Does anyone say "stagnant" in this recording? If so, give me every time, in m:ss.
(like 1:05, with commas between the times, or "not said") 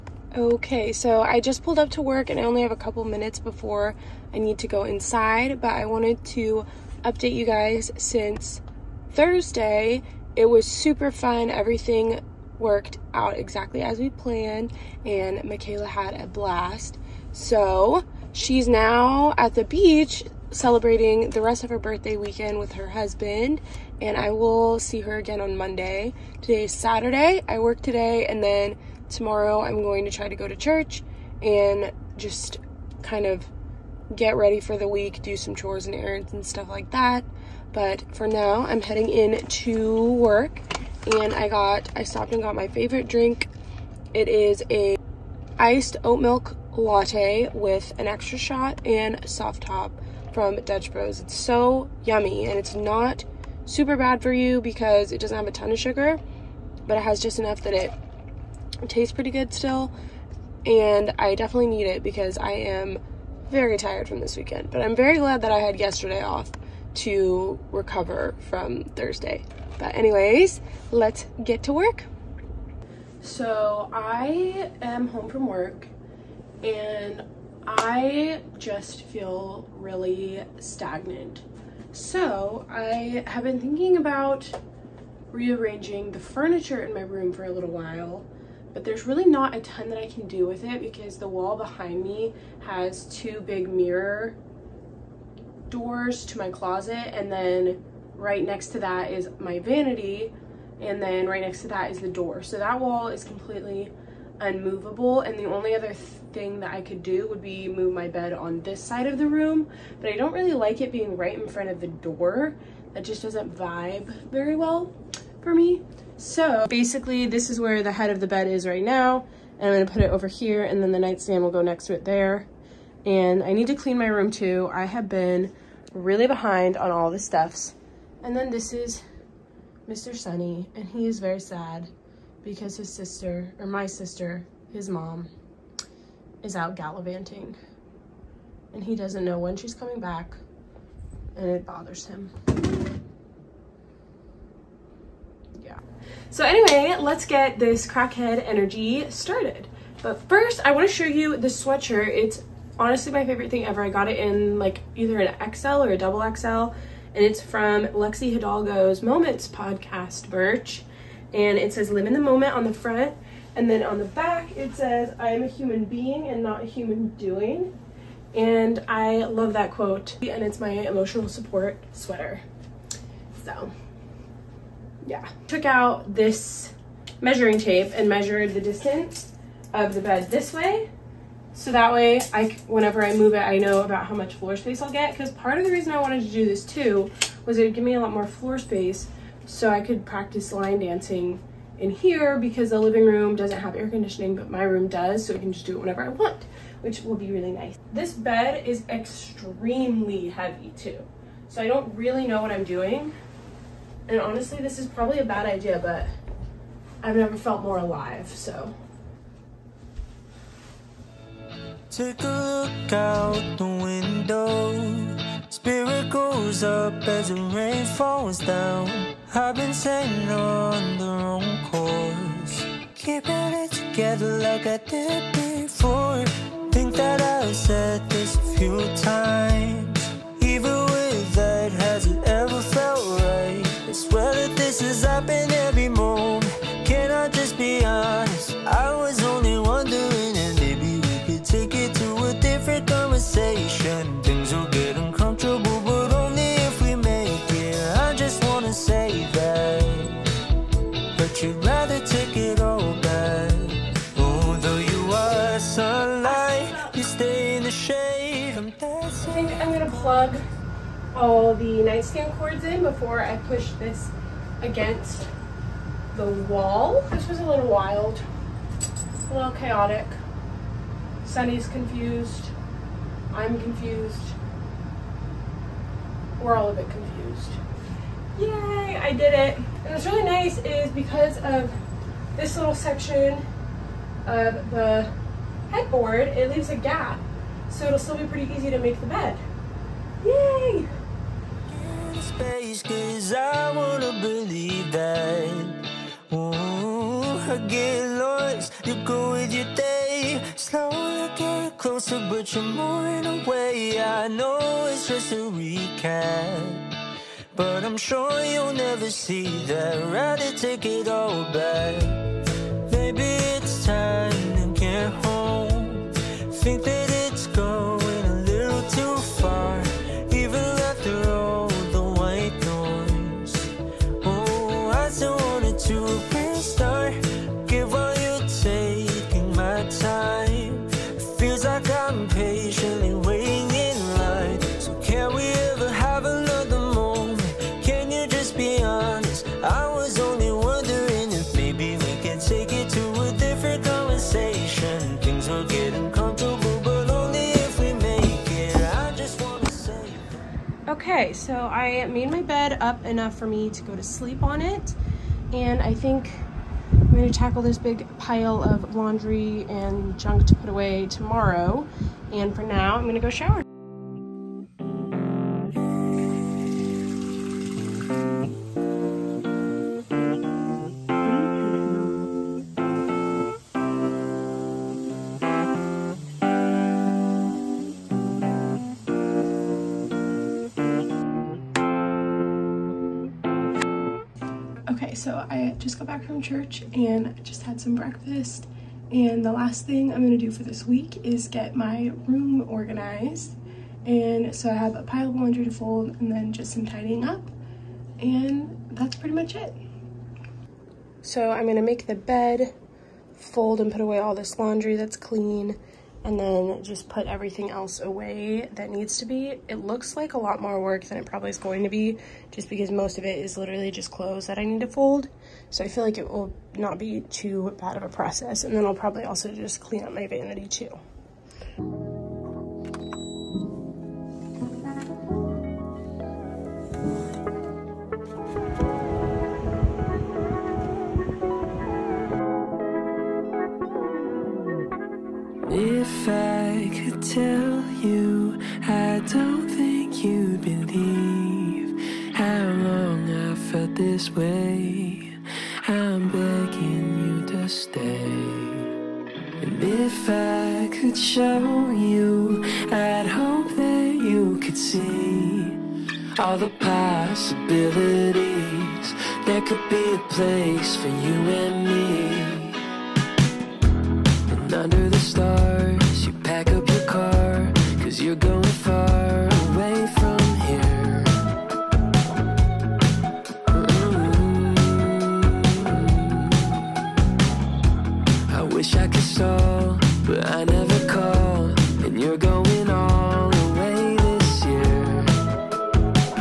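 1:20.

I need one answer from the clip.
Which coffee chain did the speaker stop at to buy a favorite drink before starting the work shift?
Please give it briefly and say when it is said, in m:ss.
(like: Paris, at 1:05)
Dutch Bros, at 0:50.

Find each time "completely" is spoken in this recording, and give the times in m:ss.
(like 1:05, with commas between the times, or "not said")
1:43.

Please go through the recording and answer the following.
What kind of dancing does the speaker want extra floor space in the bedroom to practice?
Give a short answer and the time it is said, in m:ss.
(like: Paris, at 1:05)
line dancing, at 3:10.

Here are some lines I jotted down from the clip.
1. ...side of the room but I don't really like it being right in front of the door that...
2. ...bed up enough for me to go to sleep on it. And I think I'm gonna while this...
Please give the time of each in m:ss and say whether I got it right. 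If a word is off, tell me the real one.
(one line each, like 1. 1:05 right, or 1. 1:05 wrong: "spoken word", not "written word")
1. 1:48 right
2. 5:52 wrong: "tackle", not "while".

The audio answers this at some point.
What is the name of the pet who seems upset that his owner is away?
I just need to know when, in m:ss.
2:09.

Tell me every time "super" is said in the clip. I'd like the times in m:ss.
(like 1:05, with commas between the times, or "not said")
0:10, 0:53.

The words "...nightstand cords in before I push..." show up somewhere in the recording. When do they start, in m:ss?
4:21.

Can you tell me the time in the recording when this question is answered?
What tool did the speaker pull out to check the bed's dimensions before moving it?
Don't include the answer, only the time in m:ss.
2:57.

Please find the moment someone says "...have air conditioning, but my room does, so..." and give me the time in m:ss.
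3:13.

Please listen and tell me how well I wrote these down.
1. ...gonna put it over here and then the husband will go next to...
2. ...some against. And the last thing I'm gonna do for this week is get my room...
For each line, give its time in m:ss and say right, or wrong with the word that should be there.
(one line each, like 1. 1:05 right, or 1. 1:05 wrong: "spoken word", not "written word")
1. 1:59 wrong: "nightstand", not "husband"
2. 6:27 wrong: "breakfast", not "against".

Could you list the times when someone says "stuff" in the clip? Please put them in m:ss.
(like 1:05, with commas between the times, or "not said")
0:36, 2:07.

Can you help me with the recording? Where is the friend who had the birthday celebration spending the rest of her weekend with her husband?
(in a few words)
the beach.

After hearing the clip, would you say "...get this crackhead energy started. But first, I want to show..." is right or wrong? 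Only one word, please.
right.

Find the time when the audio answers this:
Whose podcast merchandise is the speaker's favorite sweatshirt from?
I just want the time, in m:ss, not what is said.
2:37.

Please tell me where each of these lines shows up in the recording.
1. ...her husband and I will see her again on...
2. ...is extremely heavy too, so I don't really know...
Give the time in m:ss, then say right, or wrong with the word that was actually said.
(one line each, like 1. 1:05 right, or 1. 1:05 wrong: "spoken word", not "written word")
1. 0:22 right
2. 3:18 right.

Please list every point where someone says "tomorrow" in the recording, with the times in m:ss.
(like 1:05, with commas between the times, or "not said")
0:29, 6:01.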